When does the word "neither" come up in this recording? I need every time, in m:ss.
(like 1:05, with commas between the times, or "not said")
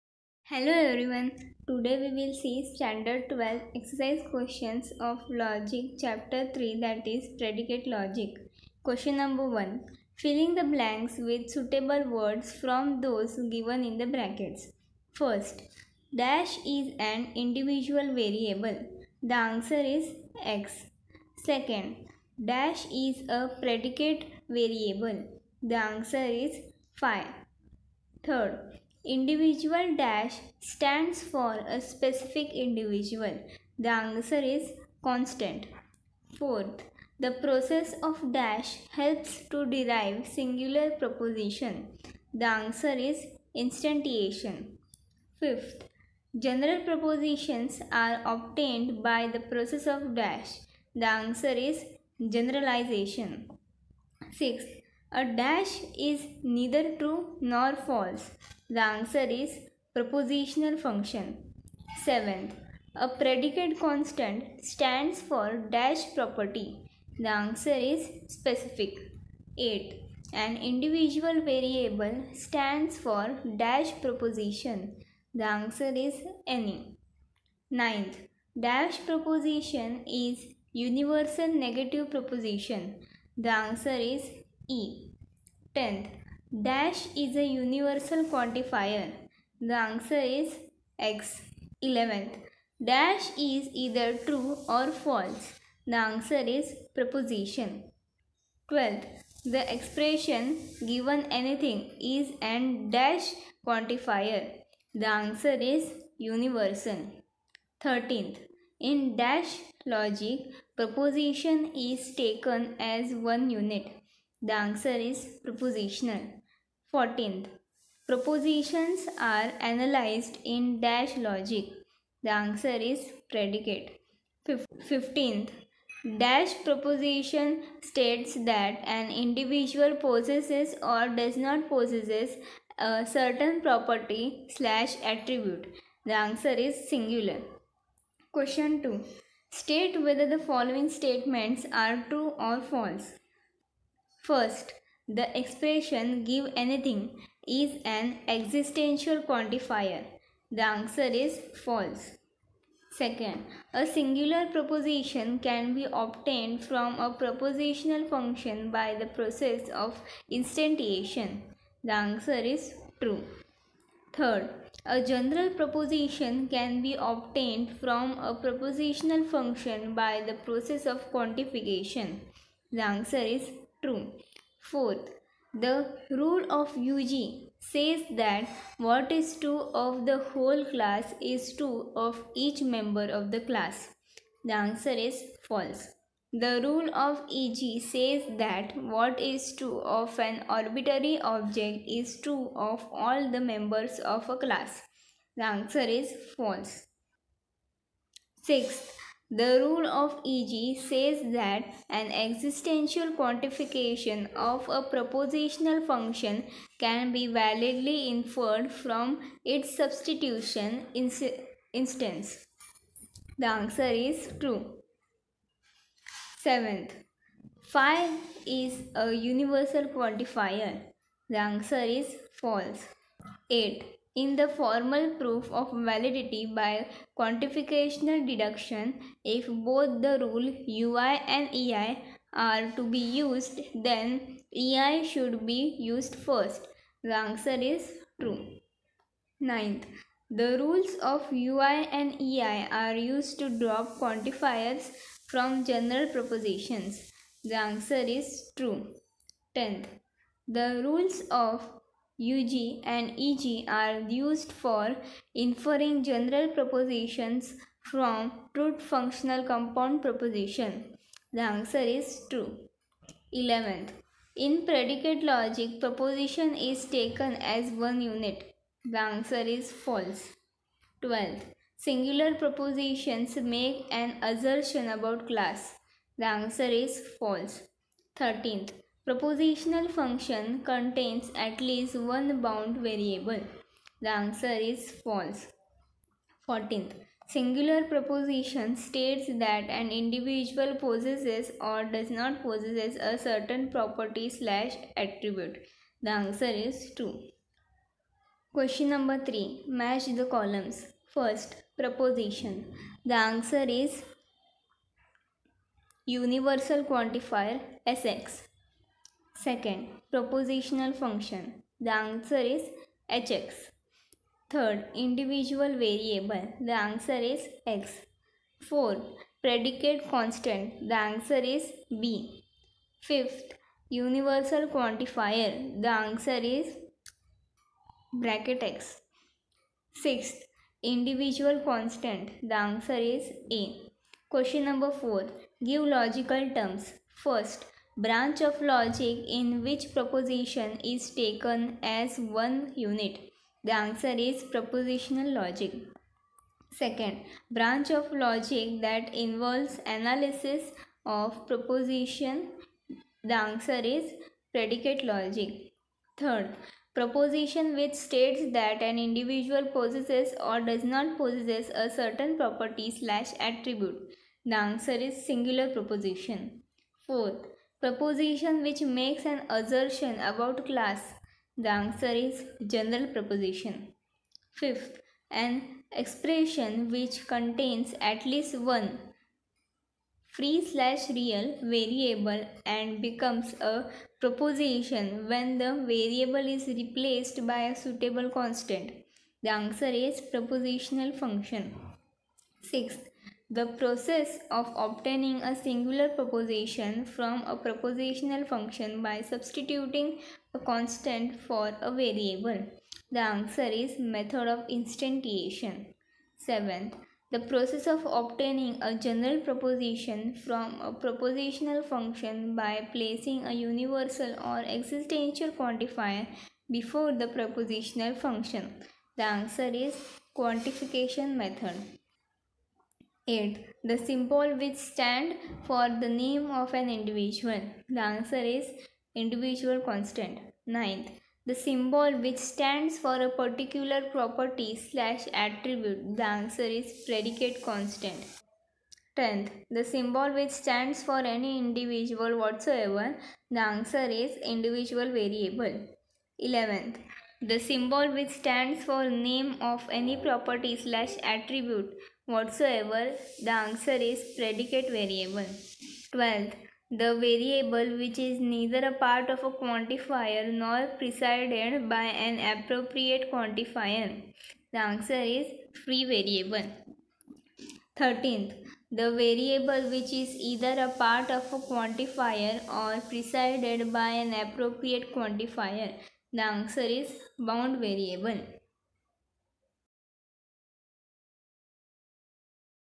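0:56, 7:38.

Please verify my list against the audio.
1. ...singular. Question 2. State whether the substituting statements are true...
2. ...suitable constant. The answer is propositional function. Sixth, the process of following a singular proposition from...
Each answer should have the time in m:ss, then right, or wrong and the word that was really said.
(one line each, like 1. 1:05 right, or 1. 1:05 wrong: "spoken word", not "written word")
1. 2:16 wrong: "following", not "substituting"
2. 6:27 wrong: "obtaining", not "following".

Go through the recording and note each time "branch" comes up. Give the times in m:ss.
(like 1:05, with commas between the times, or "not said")
5:38, 5:47.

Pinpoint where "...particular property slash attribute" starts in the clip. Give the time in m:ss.
7:13.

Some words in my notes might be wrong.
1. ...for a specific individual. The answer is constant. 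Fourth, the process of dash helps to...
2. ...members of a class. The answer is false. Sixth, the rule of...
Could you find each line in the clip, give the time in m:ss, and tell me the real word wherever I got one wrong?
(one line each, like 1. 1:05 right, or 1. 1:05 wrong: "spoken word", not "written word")
1. 0:31 right
2. 3:13 right.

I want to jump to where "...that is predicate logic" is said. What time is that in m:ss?
0:06.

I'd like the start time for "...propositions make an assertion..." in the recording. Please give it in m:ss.
4:32.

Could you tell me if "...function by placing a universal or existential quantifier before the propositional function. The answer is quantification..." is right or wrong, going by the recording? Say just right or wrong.
right.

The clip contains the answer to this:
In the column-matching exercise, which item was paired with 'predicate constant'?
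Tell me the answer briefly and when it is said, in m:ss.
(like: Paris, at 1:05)
b, at 5:20.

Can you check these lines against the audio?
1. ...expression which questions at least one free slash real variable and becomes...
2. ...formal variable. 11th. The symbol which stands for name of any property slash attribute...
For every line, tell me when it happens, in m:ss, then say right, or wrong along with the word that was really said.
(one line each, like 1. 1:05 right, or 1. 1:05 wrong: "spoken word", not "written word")
1. 6:15 wrong: "contains", not "questions"
2. 7:24 wrong: "individual", not "formal".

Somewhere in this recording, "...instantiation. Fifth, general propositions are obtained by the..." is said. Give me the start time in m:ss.
0:43.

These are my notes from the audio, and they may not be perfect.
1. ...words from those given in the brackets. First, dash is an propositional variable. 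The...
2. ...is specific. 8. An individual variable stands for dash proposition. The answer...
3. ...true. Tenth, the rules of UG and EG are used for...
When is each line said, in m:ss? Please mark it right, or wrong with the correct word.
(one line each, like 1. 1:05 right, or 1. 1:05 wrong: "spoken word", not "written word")
1. 0:12 wrong: "individual", not "propositional"
2. 1:07 right
3. 4:08 right.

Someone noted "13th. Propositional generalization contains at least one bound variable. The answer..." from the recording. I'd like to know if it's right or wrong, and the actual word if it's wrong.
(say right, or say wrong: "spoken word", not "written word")
wrong: "function", not "generalization".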